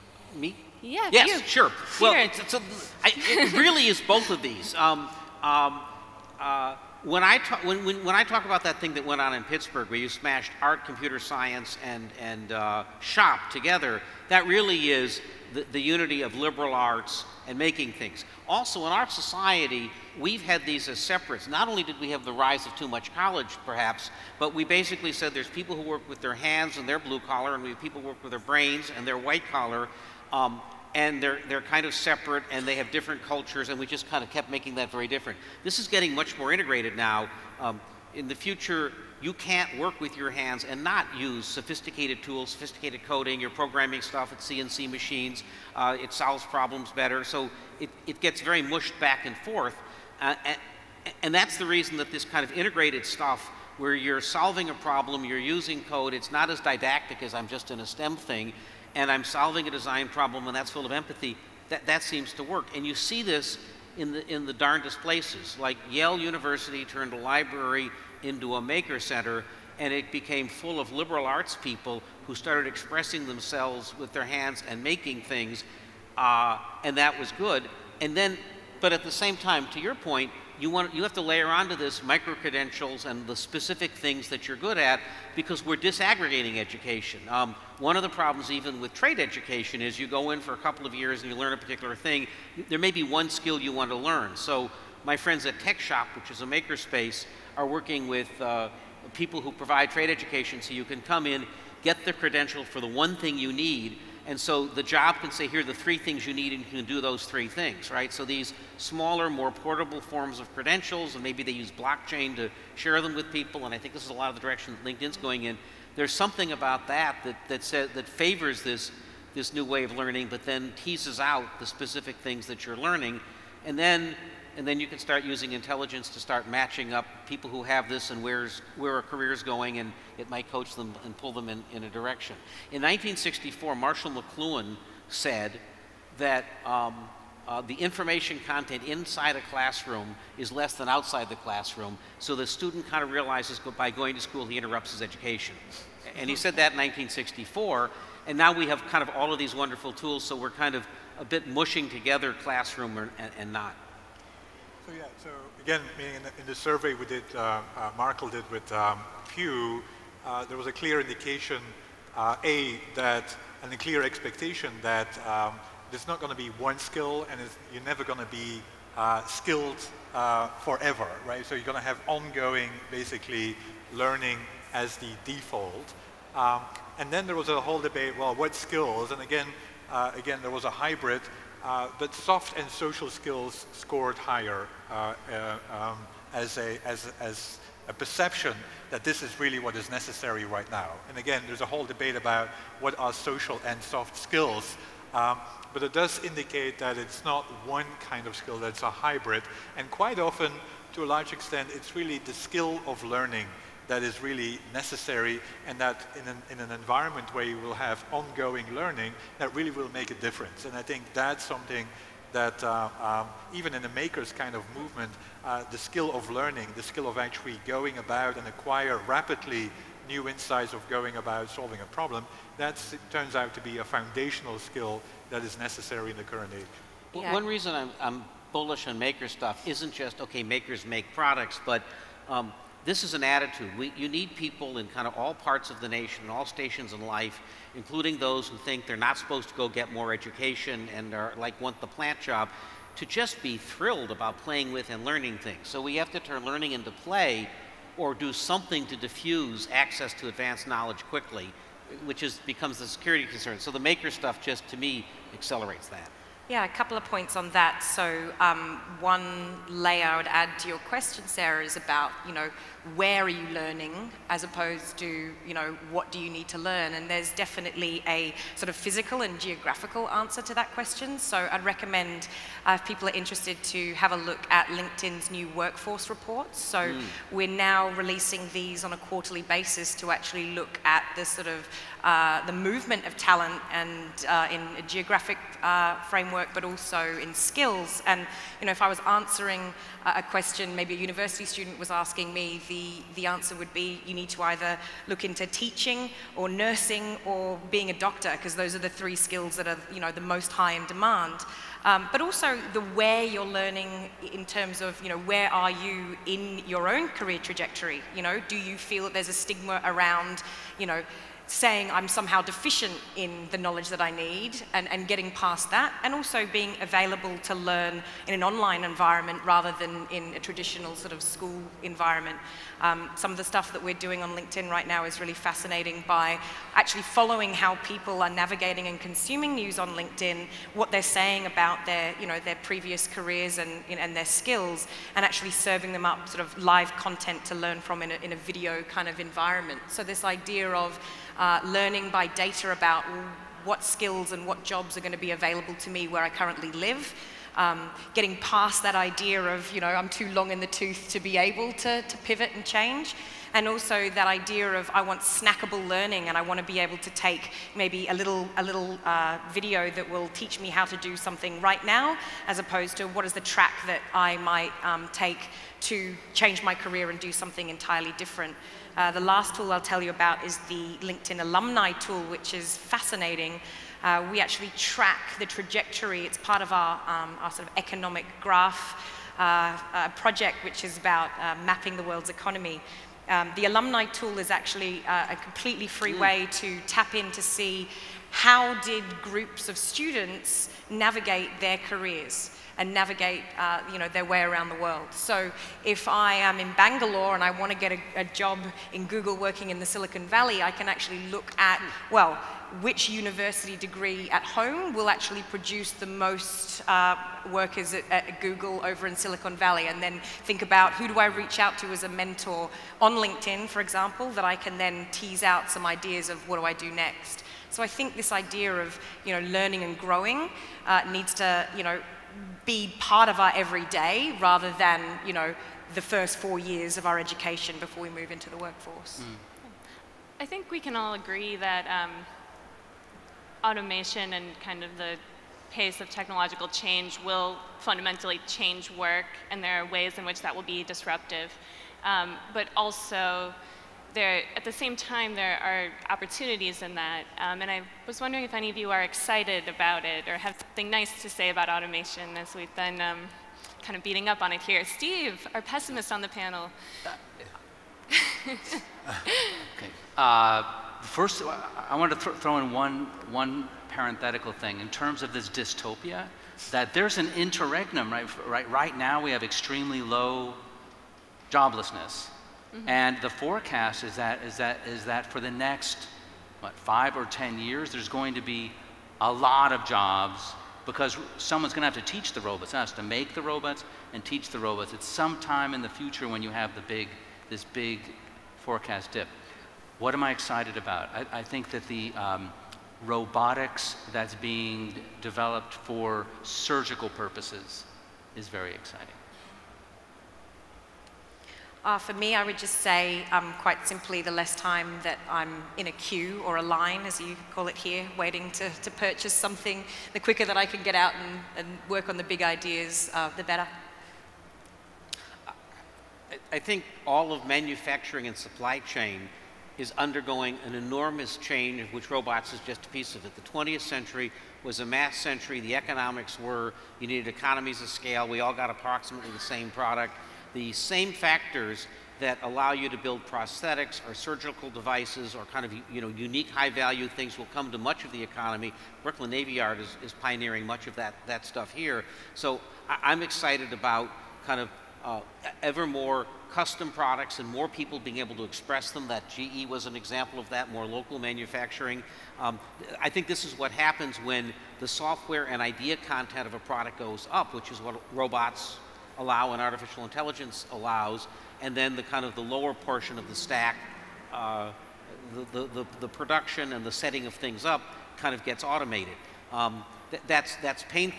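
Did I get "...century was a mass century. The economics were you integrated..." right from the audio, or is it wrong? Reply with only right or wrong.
wrong.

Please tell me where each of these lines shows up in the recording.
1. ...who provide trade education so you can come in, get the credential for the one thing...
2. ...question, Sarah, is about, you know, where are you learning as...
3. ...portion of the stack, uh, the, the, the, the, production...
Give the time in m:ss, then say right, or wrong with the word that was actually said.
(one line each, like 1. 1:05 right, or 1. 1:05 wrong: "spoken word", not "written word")
1. 1:39 right
2. 4:20 right
3. 9:22 right.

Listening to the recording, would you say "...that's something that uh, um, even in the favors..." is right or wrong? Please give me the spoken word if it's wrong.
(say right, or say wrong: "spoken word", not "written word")
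wrong: "makers", not "favors".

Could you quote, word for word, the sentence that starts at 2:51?
So you're going to have ongoing, basically, learning as the default.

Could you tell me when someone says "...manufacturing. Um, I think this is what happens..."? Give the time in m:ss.
9:11.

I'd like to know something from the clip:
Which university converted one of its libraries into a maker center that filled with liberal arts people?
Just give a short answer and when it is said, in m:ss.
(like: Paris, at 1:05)
Yale University, at 1:05.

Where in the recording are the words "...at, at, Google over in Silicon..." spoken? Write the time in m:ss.
6:47.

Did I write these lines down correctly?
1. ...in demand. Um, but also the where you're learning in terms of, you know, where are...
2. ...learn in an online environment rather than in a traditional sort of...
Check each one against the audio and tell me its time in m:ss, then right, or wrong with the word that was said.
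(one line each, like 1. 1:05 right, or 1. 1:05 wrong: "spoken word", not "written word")
1. 5:00 right
2. 5:17 right.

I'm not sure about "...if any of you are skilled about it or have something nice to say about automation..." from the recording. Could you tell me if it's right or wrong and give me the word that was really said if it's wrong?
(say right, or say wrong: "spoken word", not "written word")
wrong: "excited", not "skilled".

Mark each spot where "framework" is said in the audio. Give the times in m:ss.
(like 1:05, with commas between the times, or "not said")
4:46.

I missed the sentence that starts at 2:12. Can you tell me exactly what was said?
In 1964, Marshall McLuhan said that um, uh, the information content inside a classroom is less than outside the classroom.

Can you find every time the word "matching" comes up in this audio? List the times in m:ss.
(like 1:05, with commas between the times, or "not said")
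2:06.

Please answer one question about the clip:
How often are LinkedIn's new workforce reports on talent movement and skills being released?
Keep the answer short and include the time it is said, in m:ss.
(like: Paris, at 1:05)
quarterly, at 4:38.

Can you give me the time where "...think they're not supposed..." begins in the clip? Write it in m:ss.
3:58.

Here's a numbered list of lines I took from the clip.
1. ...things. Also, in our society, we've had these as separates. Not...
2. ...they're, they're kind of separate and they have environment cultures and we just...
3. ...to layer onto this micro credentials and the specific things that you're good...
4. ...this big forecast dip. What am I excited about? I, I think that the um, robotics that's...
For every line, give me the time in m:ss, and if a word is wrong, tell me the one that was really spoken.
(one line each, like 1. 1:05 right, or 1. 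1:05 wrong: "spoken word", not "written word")
1. 0:17 right
2. 0:31 wrong: "different", not "environment"
3. 1:21 right
4. 8:07 right.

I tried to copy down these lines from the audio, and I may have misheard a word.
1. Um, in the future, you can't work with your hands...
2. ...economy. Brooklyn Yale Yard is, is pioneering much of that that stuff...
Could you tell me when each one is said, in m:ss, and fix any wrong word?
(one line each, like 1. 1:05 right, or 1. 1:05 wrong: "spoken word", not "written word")
1. 0:37 right
2. 8:58 wrong: "Navy", not "Yale".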